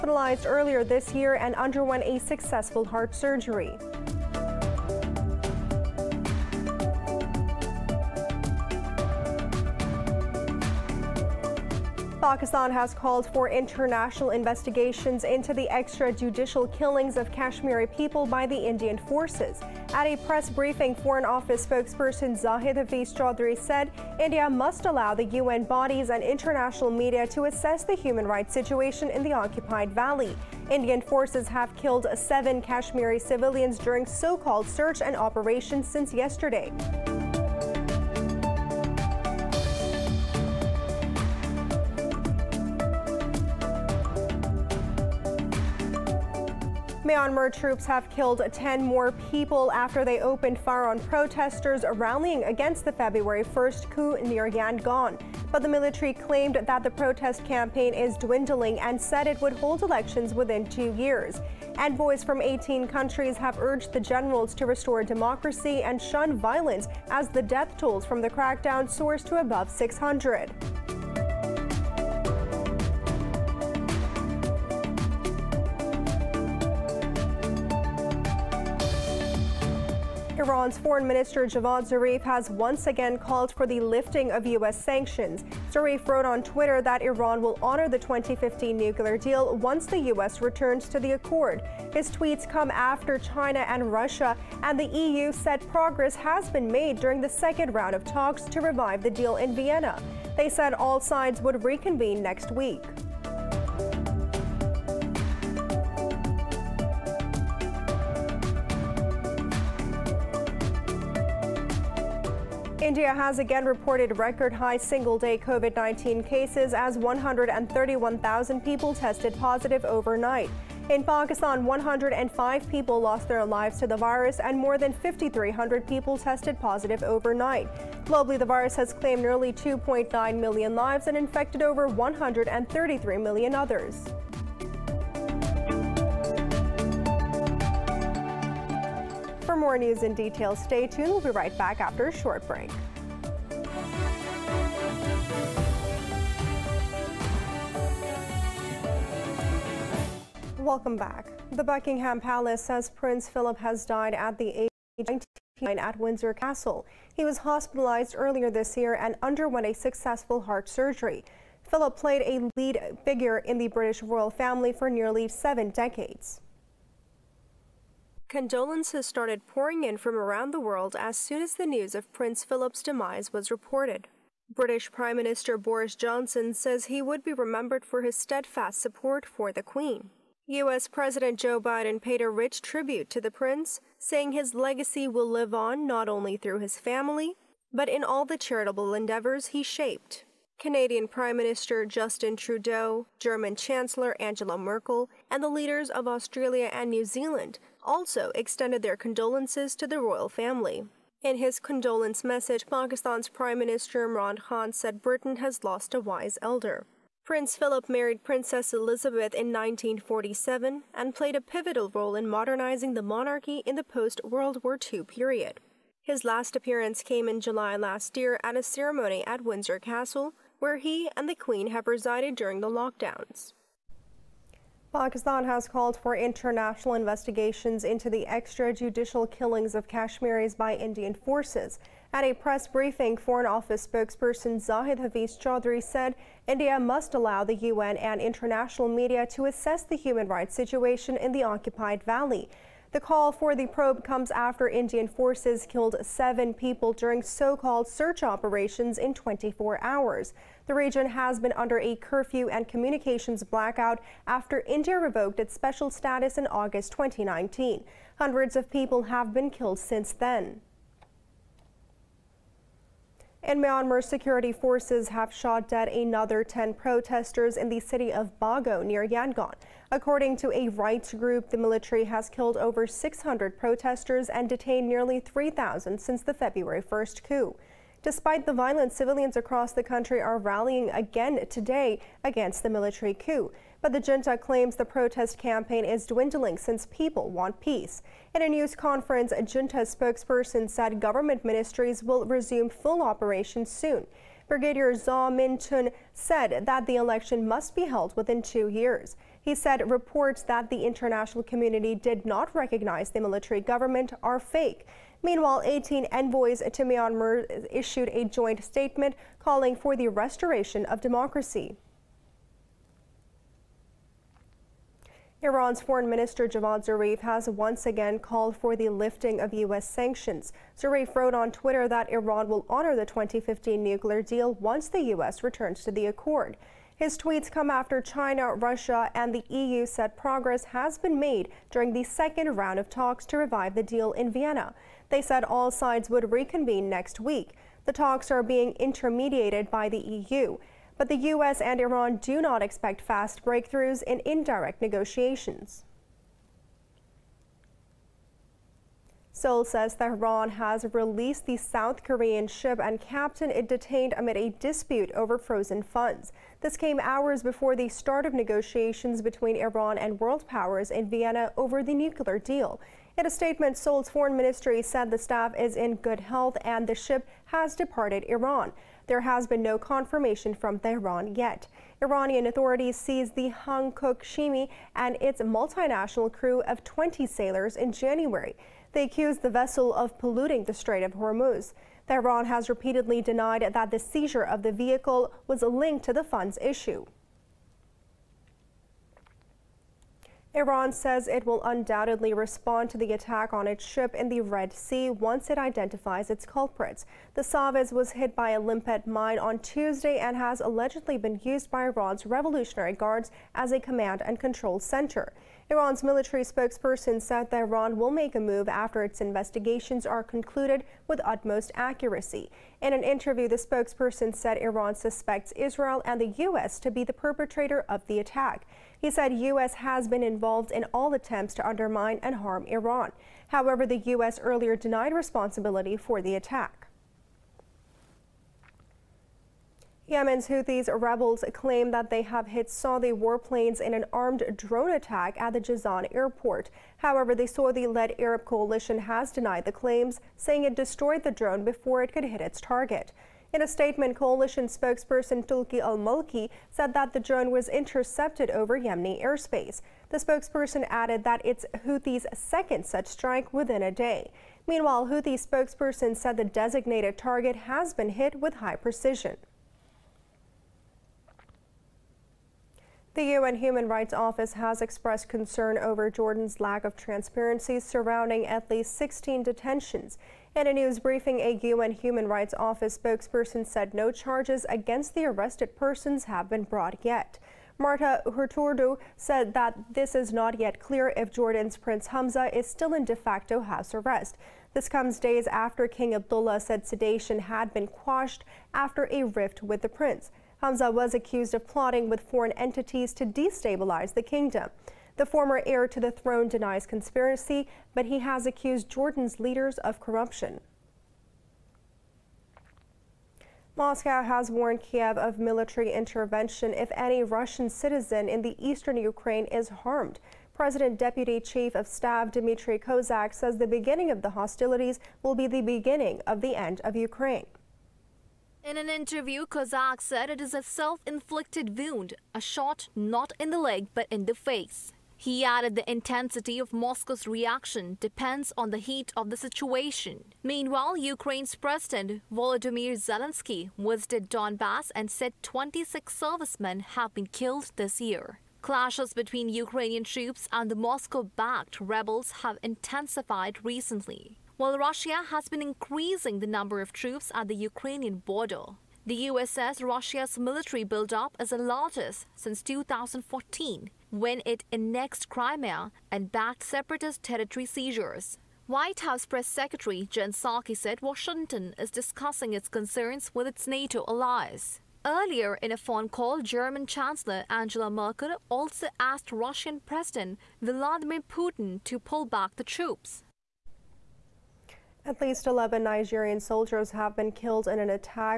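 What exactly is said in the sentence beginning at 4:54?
Brigadier Zaw Min Tun said that the election must be held within two years.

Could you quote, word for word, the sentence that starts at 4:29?
According to a rights group, the military has killed over 600 protesters and detained nearly 3,000 since the February 1st coup.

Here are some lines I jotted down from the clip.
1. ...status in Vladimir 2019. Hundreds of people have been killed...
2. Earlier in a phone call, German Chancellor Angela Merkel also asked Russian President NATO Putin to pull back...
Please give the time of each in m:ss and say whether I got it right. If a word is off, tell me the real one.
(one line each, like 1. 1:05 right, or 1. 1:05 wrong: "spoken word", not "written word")
1. 4:15 wrong: "August", not "Vladimir"
2. 9:25 wrong: "Vladimir", not "NATO".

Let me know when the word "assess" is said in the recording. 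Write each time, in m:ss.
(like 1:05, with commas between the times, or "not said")
0:27, 3:59.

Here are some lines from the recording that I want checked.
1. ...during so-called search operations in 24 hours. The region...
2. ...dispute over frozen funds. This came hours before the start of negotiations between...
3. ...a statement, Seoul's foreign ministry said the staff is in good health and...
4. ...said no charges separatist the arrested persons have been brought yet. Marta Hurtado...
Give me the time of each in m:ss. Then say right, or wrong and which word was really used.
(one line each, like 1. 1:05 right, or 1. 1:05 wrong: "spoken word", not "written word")
1. 4:06 right
2. 5:54 right
3. 6:03 right
4. 7:53 wrong: "against", not "separatist".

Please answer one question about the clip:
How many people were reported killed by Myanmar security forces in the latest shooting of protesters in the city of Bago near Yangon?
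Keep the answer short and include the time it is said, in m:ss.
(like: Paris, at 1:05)
10, at 4:26.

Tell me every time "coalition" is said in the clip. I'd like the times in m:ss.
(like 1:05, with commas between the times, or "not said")
7:18, 7:24.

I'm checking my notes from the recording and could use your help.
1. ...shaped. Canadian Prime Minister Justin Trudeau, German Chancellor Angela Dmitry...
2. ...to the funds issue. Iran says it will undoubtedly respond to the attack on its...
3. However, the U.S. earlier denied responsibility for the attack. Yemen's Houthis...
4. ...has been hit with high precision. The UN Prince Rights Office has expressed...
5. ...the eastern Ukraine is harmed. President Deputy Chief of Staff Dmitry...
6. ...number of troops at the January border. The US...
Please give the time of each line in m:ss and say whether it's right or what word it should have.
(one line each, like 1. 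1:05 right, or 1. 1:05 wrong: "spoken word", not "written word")
1. 3:09 wrong: "Merkel", not "Dmitry"
2. 6:26 right
3. 7:03 right
4. 7:37 wrong: "Human", not "Prince"
5. 8:28 right
6. 9:06 wrong: "Ukrainian", not "January".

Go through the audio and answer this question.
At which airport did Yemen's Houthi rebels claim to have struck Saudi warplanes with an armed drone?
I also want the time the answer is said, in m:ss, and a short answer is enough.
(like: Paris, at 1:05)
Jazan airport, at 7:15.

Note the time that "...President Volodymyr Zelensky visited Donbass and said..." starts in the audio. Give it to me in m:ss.
8:51.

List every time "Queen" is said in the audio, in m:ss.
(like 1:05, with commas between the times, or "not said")
2:59, 3:41.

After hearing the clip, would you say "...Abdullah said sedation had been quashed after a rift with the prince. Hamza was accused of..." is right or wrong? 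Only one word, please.
right.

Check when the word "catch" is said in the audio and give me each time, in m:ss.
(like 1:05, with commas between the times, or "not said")
not said.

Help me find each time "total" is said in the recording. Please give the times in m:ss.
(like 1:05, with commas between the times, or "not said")
not said.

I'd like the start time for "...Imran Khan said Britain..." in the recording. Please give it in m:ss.
3:24.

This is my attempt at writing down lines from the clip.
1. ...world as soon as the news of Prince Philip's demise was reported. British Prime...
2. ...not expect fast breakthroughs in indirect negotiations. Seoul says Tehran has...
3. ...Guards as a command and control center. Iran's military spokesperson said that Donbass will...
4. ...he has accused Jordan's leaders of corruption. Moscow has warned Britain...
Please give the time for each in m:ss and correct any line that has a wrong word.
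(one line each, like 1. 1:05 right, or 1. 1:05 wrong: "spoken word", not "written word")
1. 2:50 right
2. 5:42 right
3. 6:42 wrong: "Iran", not "Donbass"
4. 8:18 wrong: "Kiev", not "Britain".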